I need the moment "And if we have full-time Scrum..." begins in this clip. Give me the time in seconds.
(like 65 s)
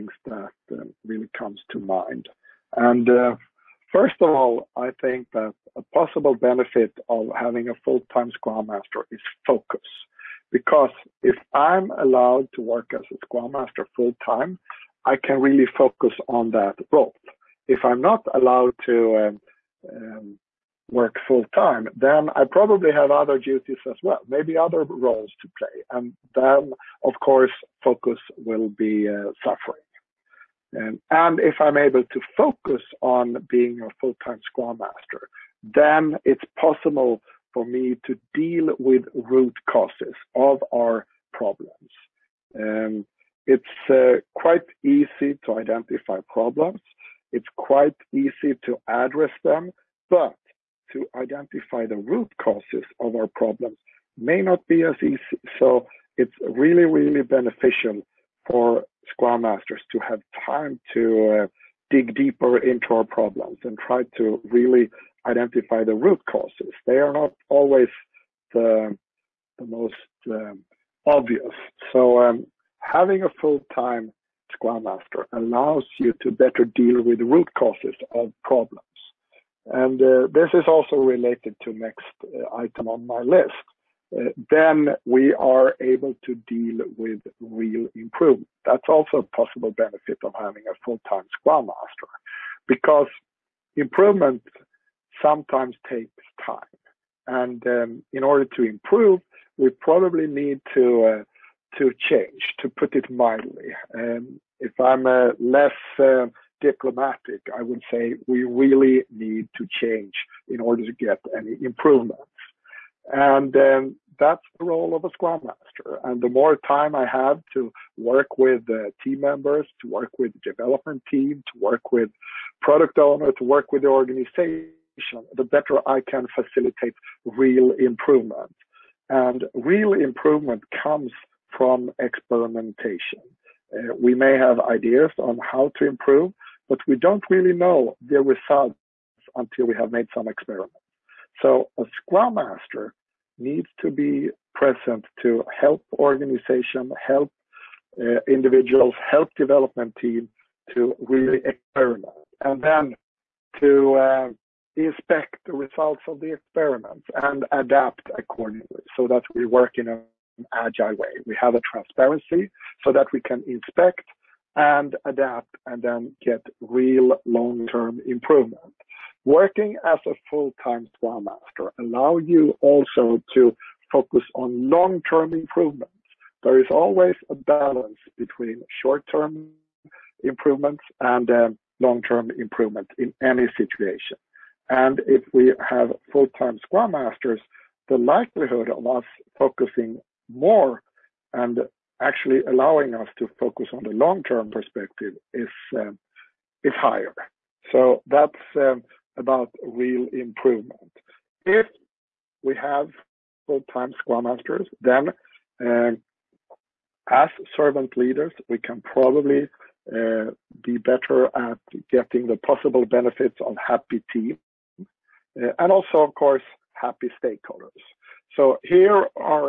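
184 s.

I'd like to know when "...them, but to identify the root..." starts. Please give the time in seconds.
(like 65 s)
49 s.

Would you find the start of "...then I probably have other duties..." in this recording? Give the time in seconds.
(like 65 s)
21 s.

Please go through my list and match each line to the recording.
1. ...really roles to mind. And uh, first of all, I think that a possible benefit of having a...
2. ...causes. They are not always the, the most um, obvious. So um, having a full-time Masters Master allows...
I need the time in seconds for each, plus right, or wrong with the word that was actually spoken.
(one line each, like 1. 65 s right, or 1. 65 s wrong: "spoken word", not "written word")
1. 1 s wrong: "comes", not "roles"
2. 66 s wrong: "Scrum", not "Masters".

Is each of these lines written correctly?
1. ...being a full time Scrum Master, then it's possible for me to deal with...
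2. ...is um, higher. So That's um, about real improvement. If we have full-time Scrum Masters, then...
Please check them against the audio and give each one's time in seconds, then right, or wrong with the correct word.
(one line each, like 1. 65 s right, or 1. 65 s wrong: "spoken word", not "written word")
1. 33 s right
2. 195 s right.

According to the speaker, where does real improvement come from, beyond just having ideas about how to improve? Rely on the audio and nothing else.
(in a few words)
Experimentation.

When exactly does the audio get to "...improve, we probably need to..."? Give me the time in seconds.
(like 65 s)
98 s.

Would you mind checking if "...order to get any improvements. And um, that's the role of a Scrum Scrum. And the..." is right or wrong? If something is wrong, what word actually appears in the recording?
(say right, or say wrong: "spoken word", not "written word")
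wrong: "Master", not "Scrum".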